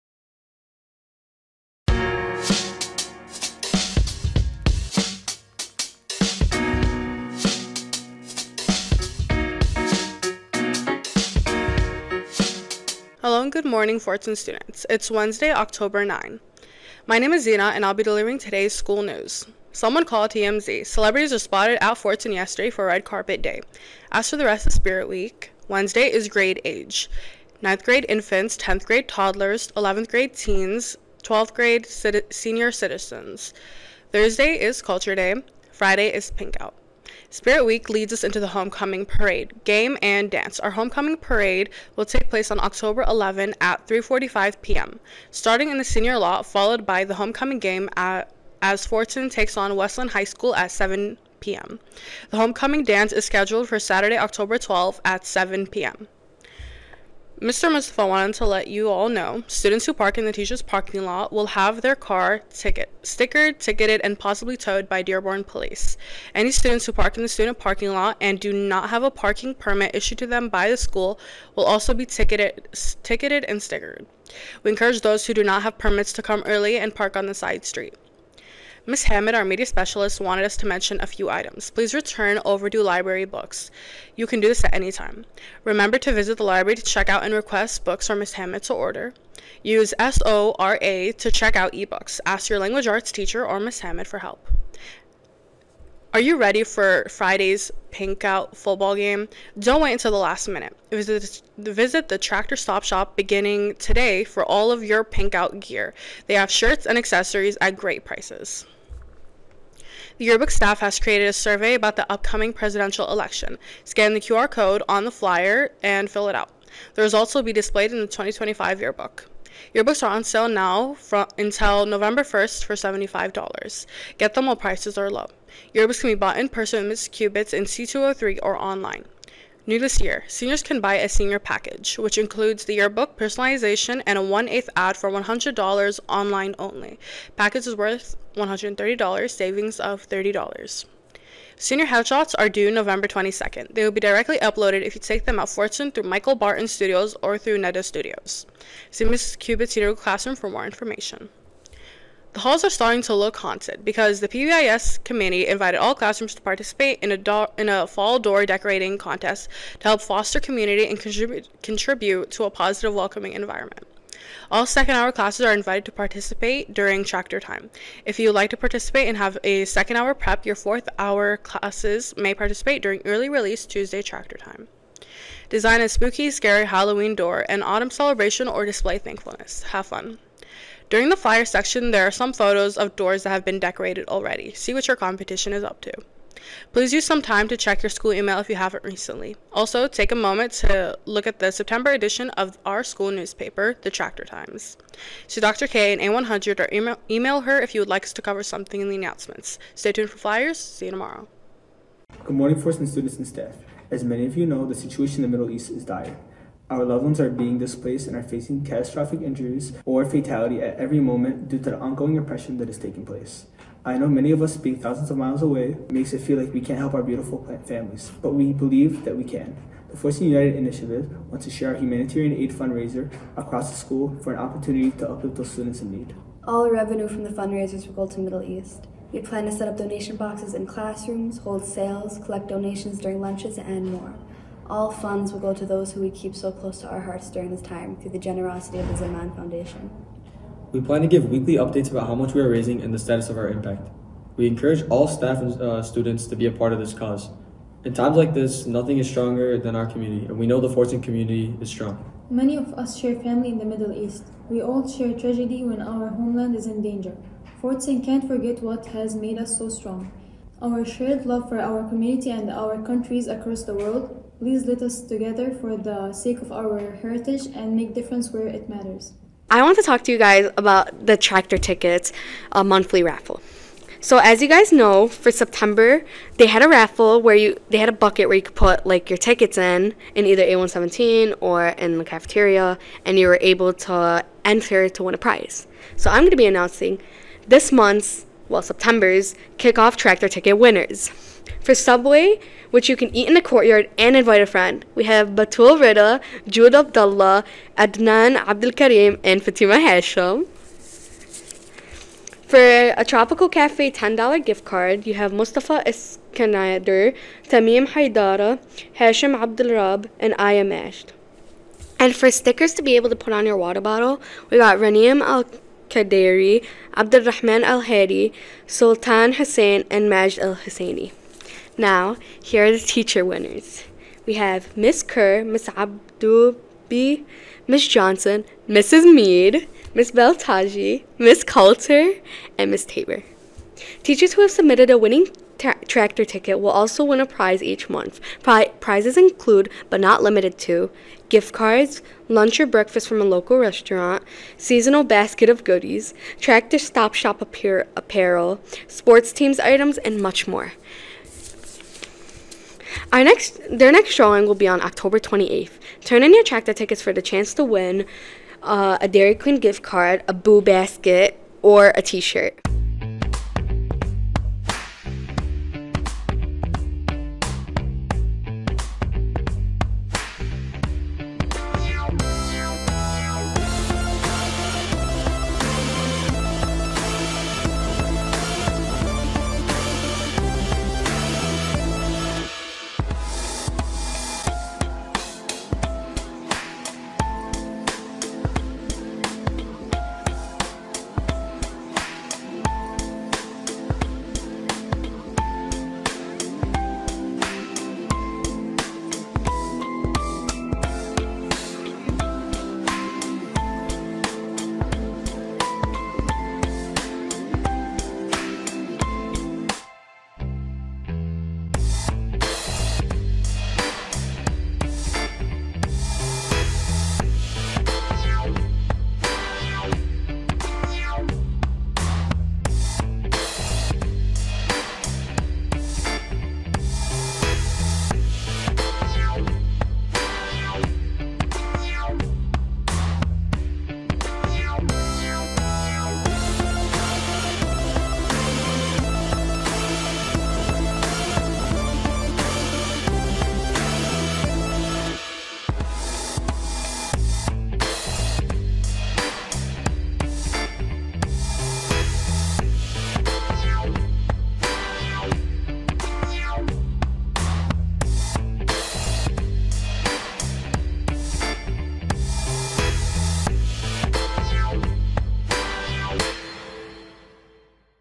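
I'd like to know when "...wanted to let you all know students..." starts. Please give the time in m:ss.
0:58.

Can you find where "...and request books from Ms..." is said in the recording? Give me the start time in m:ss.
1:27.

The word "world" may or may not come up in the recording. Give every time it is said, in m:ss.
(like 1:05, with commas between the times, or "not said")
4:23.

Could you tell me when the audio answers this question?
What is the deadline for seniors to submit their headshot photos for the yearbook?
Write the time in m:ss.
2:22.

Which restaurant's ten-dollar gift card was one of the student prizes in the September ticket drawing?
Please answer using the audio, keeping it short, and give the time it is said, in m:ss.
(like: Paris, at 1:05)
Tropical Cafe, at 5:03.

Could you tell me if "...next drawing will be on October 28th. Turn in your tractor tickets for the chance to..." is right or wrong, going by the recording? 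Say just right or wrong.
right.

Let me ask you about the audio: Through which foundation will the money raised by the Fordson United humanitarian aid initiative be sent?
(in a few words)
Zaman Foundation.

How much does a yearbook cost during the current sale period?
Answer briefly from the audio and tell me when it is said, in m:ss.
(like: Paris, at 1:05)
$75, at 2:02.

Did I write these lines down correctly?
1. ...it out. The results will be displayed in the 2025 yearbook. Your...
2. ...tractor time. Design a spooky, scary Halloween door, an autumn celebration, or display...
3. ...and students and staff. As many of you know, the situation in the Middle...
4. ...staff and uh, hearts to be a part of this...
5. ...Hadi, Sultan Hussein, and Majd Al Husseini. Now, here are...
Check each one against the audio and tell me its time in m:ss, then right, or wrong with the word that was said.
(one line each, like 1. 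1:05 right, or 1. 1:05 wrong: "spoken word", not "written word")
1. 1:56 right
2. 2:54 right
3. 3:22 right
4. 4:05 wrong: "students", not "hearts"
5. 5:17 right.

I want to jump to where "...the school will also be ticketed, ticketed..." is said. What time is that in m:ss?
1:10.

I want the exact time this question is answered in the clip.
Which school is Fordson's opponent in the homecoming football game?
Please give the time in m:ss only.
0:49.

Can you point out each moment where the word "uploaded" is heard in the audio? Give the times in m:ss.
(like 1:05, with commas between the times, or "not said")
2:24.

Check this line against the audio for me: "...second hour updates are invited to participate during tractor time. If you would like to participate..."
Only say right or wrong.
wrong.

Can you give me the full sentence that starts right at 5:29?
Mead, Miss Beltaji, Miss Coulter, and Miss Tabor.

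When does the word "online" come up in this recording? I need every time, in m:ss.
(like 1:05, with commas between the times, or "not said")
2:08, 2:16.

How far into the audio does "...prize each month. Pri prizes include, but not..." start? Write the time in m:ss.
5:37.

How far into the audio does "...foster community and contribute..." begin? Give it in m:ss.
2:40.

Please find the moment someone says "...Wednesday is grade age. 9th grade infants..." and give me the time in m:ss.
0:25.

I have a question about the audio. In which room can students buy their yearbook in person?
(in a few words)
C203.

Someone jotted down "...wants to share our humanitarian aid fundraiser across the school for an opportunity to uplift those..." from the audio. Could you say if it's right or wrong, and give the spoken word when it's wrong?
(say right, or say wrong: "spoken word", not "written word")
right.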